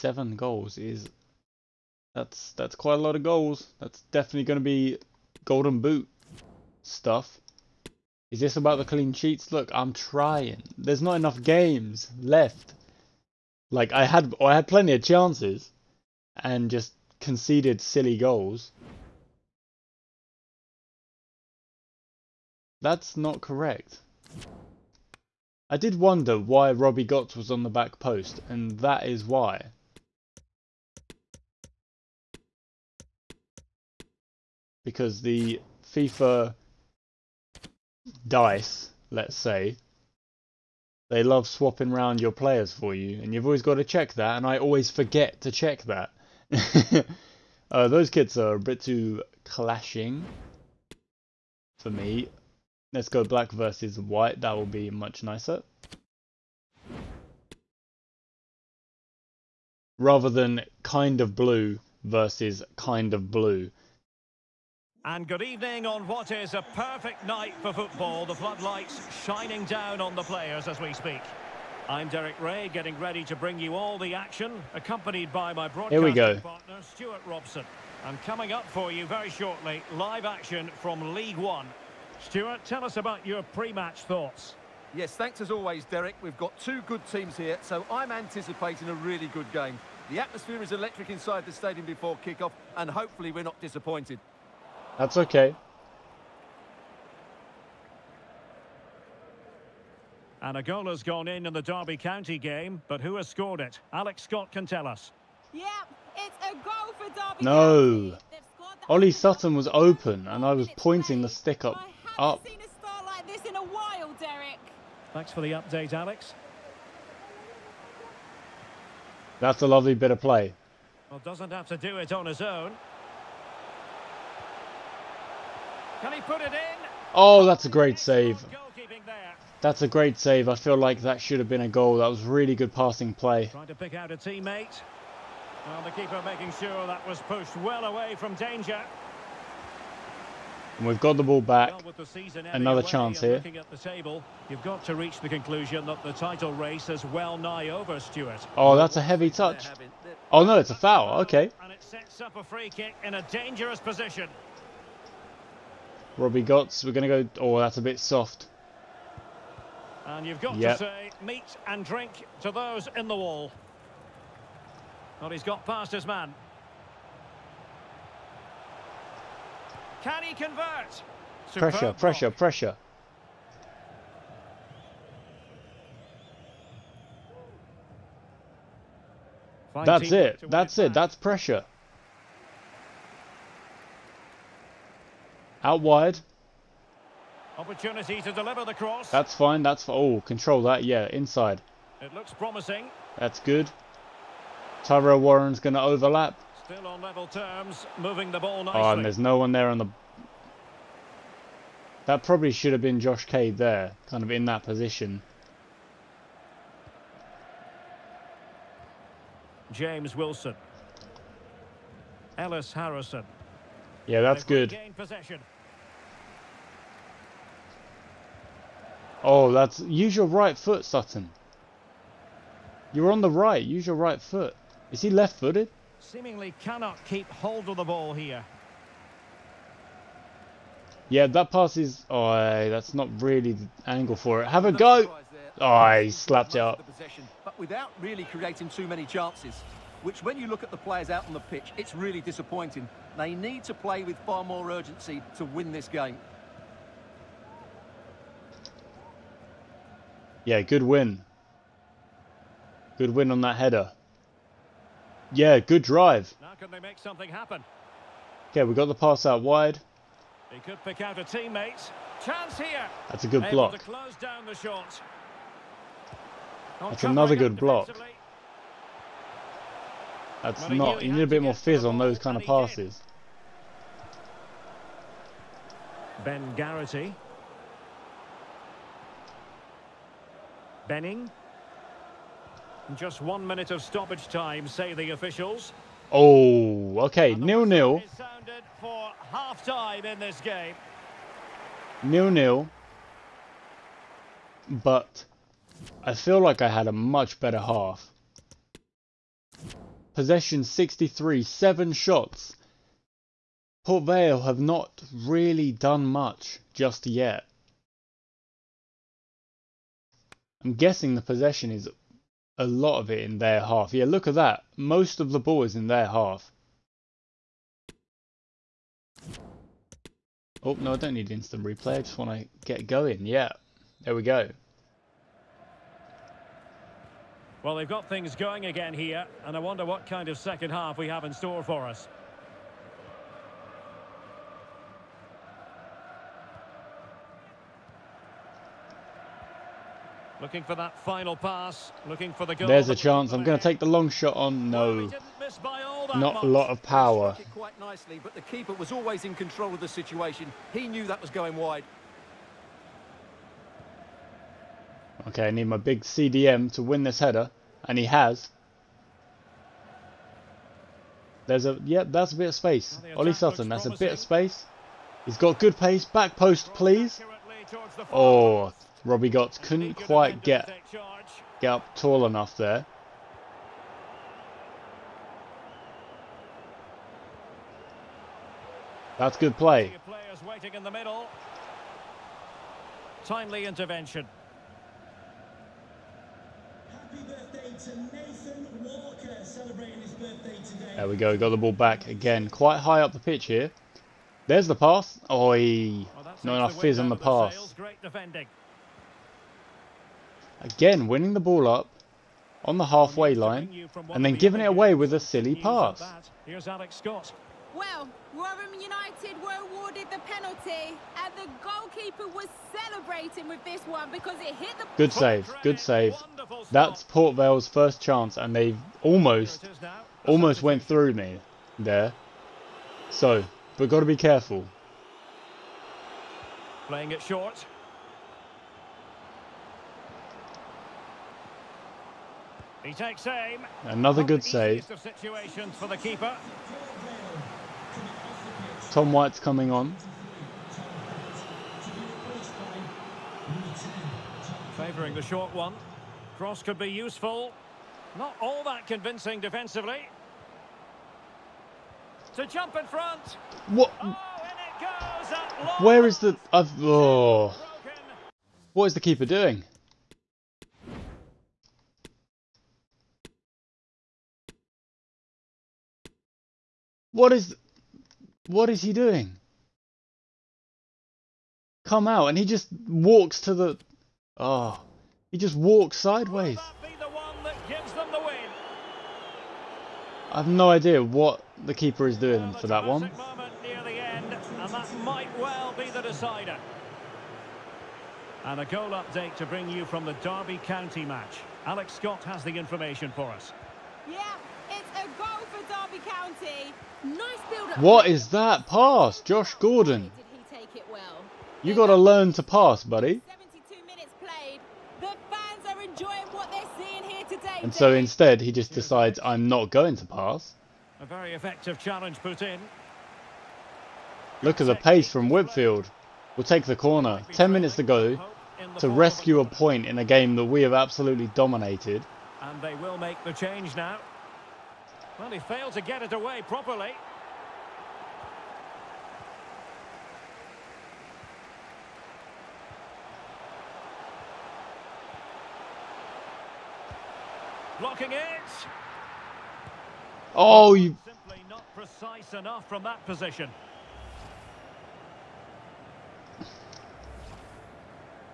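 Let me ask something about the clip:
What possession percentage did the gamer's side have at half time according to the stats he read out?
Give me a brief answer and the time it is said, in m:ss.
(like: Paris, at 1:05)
63, at 5:00.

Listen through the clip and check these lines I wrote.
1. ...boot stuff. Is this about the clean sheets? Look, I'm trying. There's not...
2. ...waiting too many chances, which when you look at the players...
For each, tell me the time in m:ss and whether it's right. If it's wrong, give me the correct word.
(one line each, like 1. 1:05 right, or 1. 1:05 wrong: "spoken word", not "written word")
1. 0:05 right
2. 3:58 wrong: "creating", not "waiting".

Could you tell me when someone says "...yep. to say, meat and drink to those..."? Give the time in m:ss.
2:40.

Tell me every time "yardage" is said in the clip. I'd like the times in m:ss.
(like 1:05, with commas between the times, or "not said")
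not said.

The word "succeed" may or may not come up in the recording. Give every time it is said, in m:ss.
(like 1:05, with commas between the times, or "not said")
not said.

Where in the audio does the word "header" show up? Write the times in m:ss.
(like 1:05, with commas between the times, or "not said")
4:13, 5:57.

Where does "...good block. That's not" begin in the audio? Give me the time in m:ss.
4:27.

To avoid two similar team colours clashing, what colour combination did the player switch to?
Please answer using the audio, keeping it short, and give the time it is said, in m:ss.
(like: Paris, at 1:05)
Black versus white, at 0:53.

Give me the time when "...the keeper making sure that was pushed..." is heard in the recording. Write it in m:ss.
2:15.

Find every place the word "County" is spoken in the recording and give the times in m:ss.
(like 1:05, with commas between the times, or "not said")
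1:41, 1:48, 8:10.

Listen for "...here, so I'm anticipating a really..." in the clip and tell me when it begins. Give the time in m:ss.
1:27.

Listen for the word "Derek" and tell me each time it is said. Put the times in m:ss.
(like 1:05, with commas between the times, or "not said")
1:12, 1:25.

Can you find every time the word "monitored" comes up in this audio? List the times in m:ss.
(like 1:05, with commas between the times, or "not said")
not said.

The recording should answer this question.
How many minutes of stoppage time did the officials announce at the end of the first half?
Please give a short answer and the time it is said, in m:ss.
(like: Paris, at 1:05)
1, at 4:43.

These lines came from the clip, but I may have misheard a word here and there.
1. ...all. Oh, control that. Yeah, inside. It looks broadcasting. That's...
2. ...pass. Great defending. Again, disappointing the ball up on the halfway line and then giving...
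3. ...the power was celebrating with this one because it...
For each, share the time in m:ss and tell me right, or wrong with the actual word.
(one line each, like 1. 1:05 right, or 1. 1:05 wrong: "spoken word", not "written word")
1. 3:09 wrong: "promising", not "broadcasting"
2. 6:37 wrong: "winning", not "disappointing"
3. 6:51 wrong: "goalkeeper", not "power".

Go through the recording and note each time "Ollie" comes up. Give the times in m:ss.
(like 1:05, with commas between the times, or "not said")
1:48, 6:03.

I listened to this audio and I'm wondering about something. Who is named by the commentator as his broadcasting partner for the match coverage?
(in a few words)
Stuart Robson.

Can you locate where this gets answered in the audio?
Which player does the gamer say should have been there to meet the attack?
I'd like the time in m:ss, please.
3:23.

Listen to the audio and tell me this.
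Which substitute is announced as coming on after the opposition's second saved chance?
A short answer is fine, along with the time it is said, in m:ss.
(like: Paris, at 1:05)
Tom White, at 7:18.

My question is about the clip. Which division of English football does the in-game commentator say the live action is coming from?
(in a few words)
League One.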